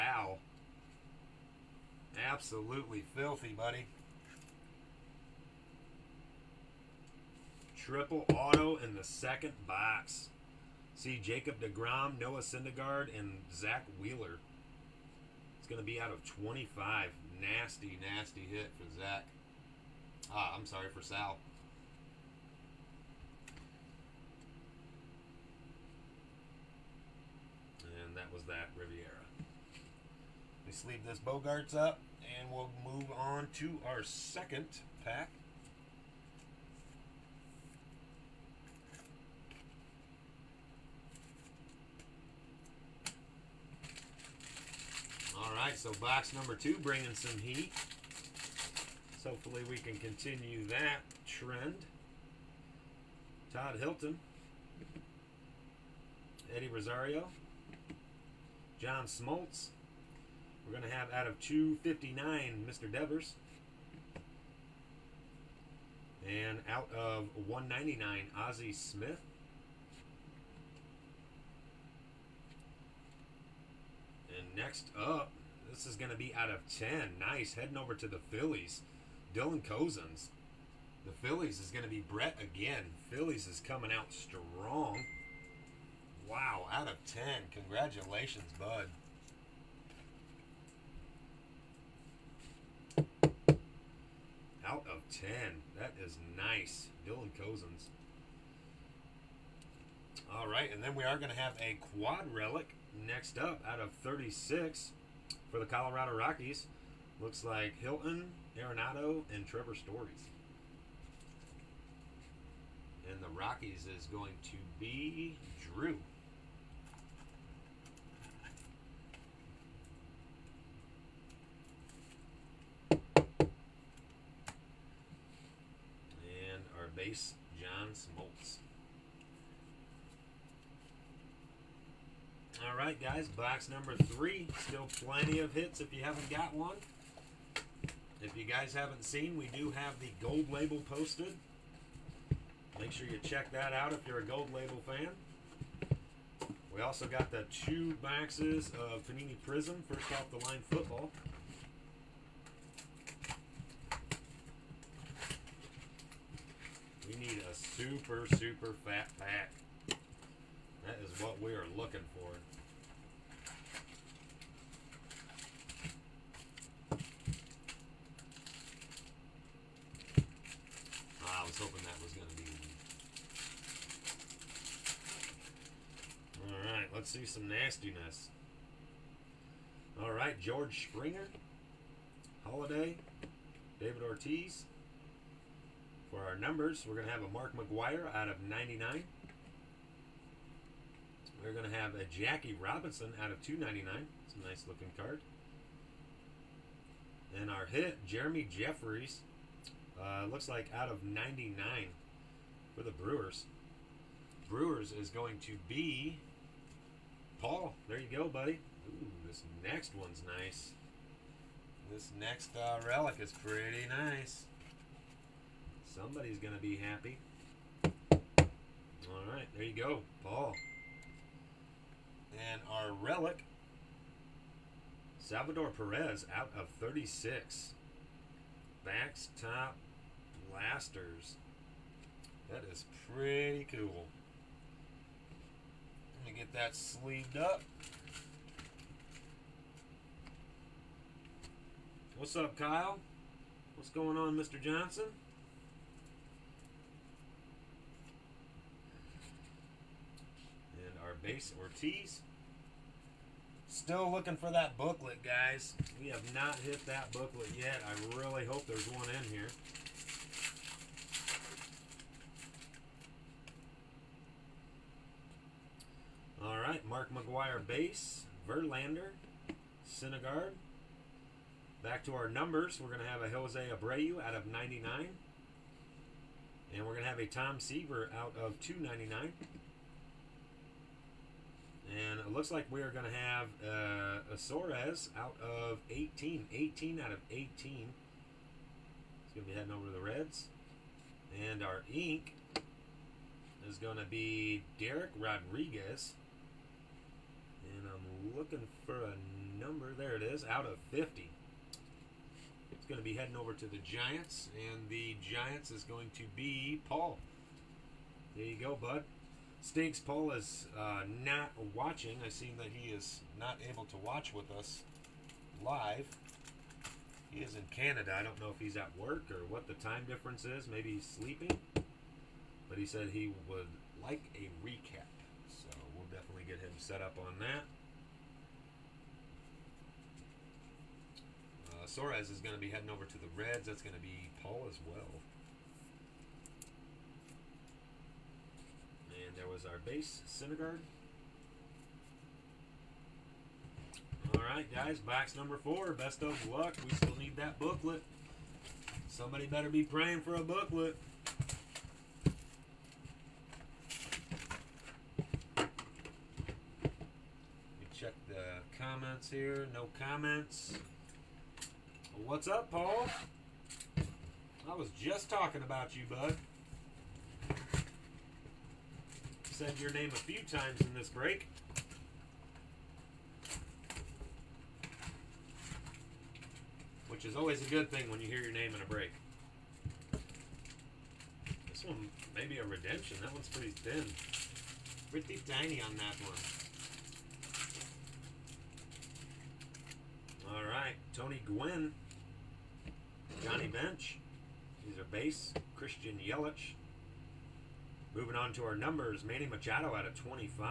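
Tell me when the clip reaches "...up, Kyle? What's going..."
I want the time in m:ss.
4:02.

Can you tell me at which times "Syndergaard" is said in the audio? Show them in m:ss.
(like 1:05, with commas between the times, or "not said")
0:12, 4:29, 5:40.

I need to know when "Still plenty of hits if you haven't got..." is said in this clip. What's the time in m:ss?
2:14.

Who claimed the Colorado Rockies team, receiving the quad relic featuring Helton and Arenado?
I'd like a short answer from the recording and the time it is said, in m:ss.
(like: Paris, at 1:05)
Drew, at 1:55.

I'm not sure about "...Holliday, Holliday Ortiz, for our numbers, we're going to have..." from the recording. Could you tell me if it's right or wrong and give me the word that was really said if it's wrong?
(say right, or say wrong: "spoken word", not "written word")
wrong: "David", not "Holliday".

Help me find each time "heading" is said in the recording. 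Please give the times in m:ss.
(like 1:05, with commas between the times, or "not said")
1:17, 4:49, 5:03, 5:32.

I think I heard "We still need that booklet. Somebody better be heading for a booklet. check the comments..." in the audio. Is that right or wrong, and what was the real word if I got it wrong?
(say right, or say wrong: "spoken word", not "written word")
wrong: "praying", not "heading".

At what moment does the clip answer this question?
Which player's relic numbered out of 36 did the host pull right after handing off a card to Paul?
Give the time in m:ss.
3:45.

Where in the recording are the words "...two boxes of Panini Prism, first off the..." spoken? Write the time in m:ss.
2:27.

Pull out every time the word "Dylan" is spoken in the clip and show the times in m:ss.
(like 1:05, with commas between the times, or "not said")
1:19, 1:37.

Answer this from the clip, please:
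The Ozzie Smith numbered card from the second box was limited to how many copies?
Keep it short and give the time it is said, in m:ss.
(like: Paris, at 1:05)
199, at 1:07.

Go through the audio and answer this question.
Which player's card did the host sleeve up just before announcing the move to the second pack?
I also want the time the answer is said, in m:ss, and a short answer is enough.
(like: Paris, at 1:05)
Bogaerts, at 0:31.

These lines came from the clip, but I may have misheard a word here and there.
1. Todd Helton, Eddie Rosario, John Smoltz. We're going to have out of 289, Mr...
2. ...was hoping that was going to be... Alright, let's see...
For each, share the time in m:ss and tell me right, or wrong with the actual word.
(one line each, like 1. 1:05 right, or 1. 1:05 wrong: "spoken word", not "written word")
1. 0:53 wrong: "259", not "289"
2. 2:51 right.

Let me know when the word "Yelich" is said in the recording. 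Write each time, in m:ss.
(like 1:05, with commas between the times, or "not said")
6:36.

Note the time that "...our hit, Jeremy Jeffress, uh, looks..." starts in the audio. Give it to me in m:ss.
3:17.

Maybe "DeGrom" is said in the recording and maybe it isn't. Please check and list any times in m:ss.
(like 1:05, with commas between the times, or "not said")
0:11.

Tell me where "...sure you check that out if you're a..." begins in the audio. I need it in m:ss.
2:22.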